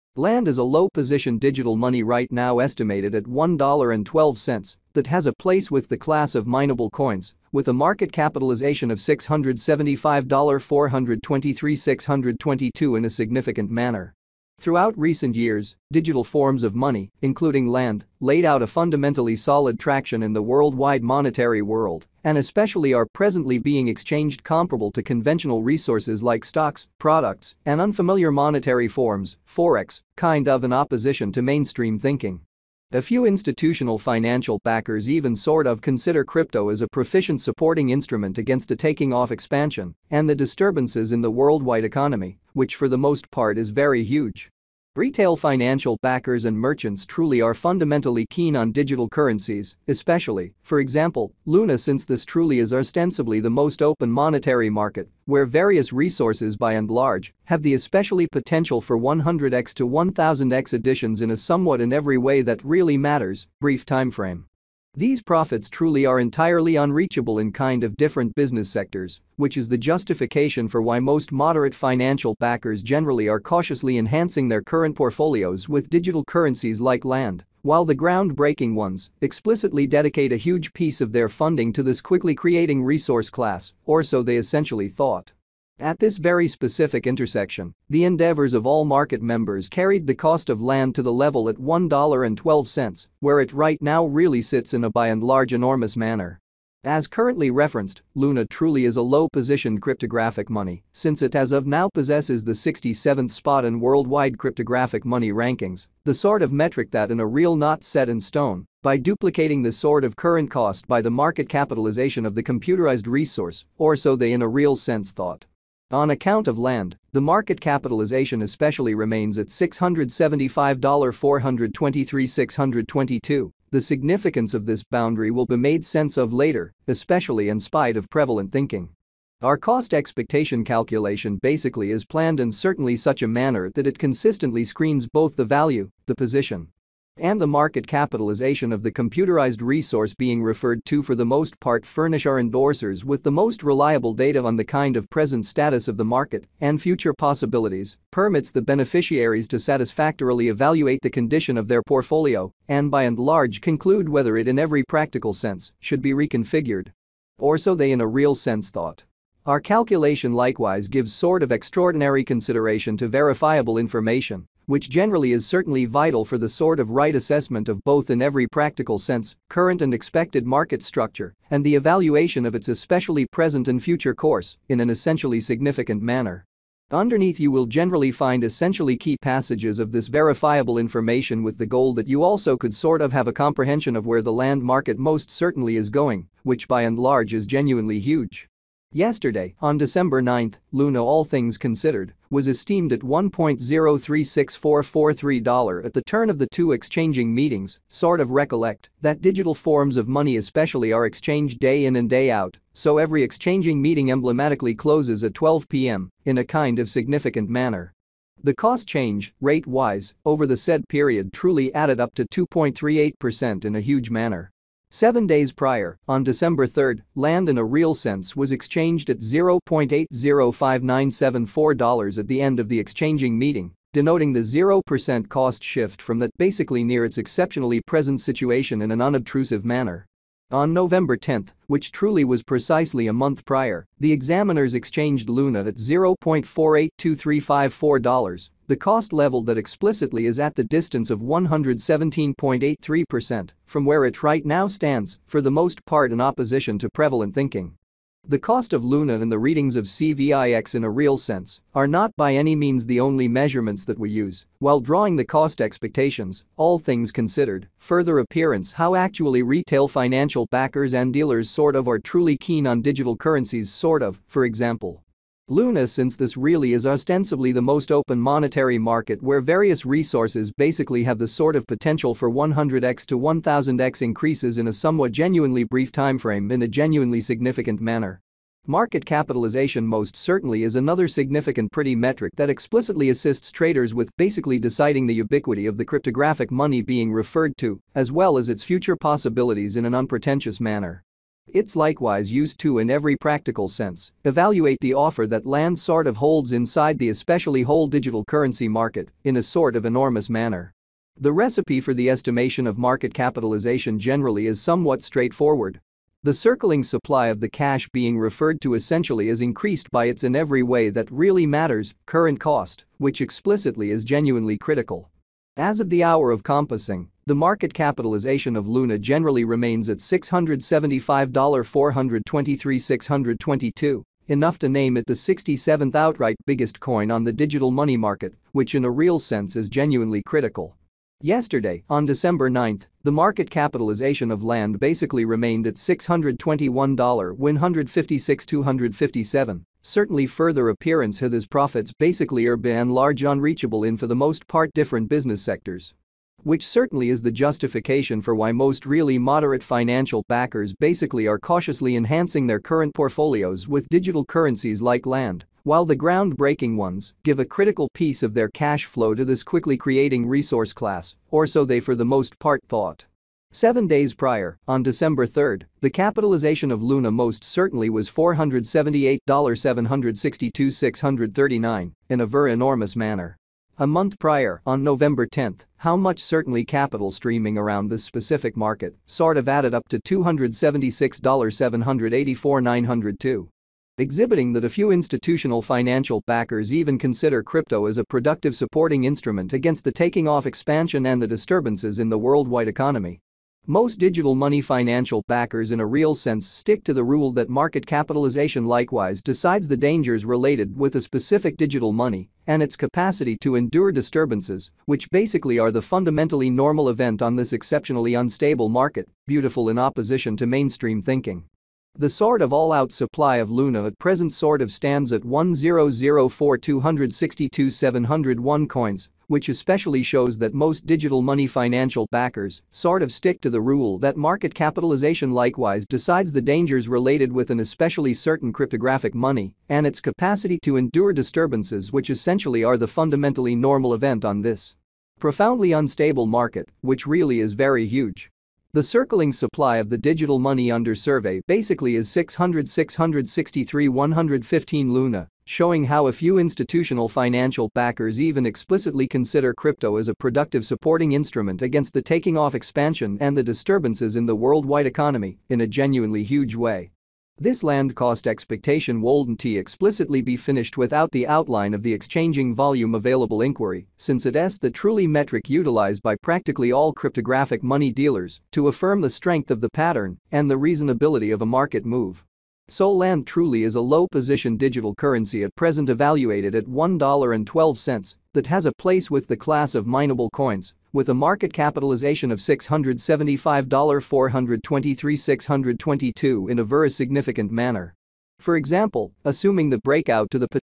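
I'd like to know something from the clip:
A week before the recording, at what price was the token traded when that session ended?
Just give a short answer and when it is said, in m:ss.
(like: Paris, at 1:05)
$0.805974, at 3:39.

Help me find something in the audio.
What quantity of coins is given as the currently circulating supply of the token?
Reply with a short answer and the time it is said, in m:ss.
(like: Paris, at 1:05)
600663115, at 7:22.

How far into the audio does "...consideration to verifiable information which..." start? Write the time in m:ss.
2:42.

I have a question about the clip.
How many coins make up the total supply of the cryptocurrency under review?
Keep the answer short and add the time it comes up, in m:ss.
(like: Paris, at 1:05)
1004262701, at 6:55.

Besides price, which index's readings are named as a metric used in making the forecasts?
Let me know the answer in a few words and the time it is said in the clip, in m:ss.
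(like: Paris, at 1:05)
CVIX, at 4:09.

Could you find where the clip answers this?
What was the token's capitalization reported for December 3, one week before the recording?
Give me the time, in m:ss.
6:08.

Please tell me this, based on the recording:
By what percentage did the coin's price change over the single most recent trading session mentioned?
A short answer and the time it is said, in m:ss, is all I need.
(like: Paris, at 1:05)
2.38%, at 3:32.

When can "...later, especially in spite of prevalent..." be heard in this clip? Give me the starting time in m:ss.
2:06.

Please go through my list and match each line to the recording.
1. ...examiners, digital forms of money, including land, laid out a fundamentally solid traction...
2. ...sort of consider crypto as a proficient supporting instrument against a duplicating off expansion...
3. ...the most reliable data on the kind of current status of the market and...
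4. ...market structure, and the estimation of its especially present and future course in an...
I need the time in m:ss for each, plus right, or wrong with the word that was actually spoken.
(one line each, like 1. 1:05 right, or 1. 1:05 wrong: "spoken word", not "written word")
1. 0:15 wrong: "years", not "examiners"
2. 0:35 wrong: "taking", not "duplicating"
3. 2:23 wrong: "present", not "current"
4. 2:50 wrong: "evaluation", not "estimation".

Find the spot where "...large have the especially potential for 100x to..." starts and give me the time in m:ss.
0:56.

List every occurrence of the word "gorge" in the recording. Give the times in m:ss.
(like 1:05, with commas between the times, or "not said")
not said.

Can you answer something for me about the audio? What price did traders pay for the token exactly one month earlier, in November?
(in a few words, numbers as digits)
$0.482354.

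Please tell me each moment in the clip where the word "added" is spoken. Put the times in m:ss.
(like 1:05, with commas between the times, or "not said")
3:31, 6:19.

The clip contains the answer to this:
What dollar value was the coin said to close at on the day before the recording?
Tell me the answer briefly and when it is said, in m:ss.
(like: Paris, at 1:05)
$1.036443, at 3:12.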